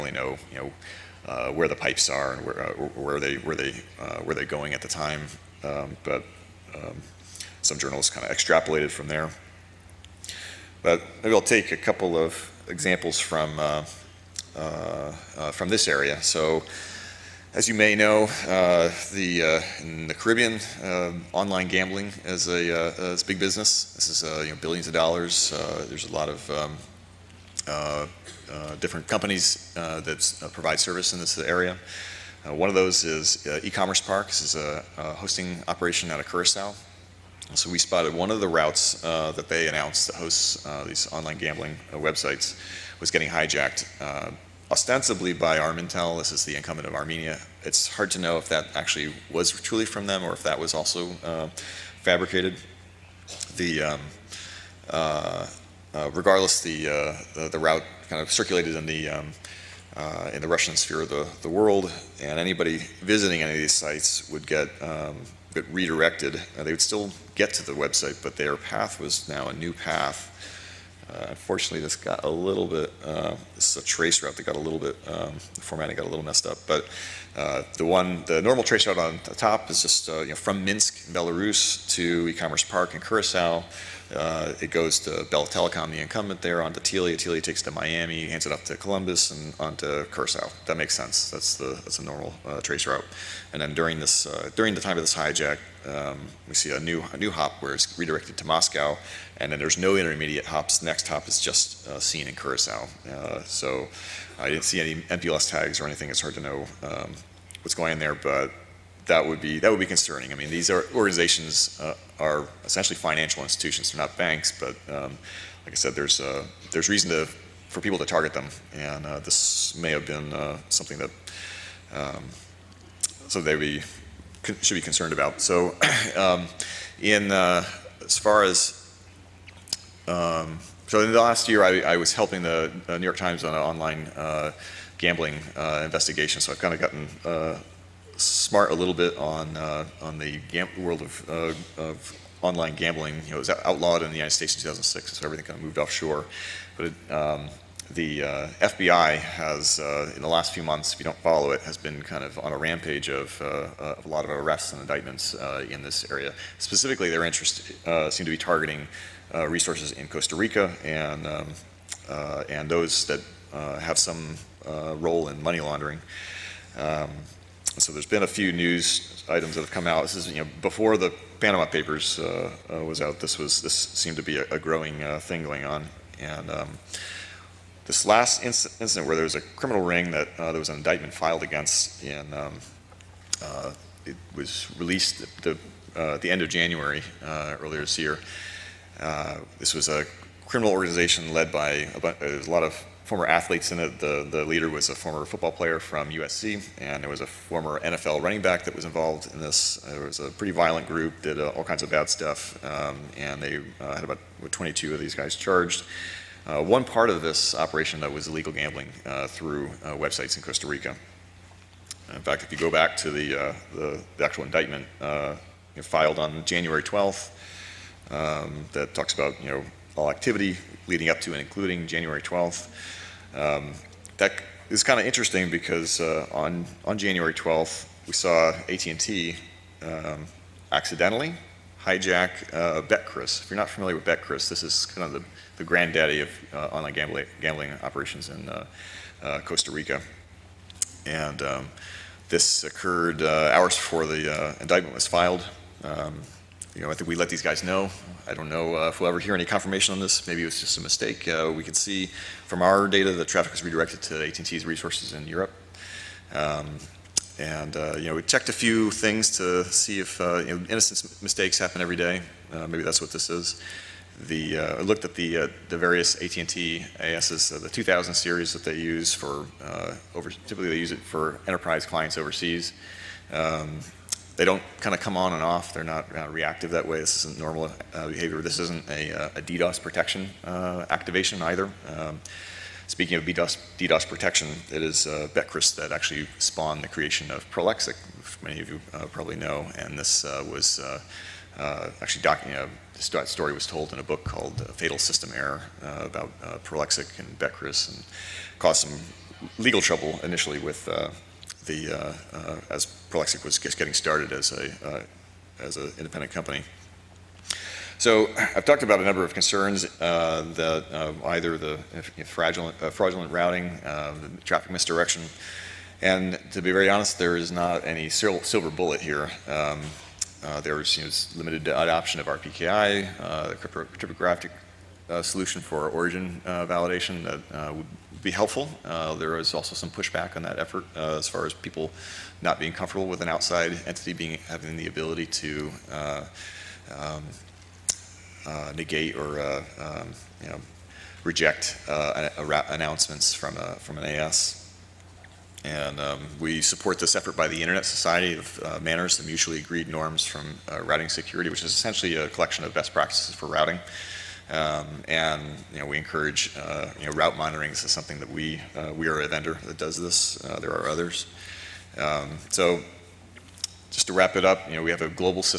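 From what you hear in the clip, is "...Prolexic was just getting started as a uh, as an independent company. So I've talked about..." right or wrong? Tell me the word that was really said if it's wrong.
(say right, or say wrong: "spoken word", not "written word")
right.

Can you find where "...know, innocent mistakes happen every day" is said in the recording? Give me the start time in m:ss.
4:20.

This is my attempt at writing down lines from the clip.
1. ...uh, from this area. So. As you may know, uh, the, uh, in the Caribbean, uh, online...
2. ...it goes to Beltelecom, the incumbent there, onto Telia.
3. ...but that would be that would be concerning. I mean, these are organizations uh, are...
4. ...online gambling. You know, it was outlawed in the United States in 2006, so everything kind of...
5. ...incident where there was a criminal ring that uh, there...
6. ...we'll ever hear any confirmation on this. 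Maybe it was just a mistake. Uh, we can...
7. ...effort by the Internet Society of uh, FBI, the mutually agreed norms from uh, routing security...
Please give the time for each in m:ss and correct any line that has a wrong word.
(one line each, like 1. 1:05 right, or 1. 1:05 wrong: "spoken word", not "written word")
1. 0:14 right
2. 1:24 right
3. 1:48 right
4. 2:22 right
5. 2:58 right
6. 4:08 right
7. 5:47 wrong: "MANRS", not "FBI".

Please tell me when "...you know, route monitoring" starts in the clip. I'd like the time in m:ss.
5:56.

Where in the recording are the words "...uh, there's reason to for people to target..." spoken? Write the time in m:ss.
1:56.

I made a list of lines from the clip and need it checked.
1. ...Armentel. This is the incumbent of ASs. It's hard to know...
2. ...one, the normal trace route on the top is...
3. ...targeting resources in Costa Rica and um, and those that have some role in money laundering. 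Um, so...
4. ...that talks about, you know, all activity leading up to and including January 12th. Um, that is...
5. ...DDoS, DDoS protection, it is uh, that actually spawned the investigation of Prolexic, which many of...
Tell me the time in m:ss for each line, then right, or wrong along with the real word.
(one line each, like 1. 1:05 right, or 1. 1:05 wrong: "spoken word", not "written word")
1. 0:45 wrong: "Armenia", not "ASs"
2. 1:17 right
3. 2:38 right
4. 3:38 right
5. 4:43 wrong: "creation", not "investigation".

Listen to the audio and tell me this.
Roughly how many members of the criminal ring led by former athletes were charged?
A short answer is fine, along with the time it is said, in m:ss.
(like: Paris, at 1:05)
22, at 3:24.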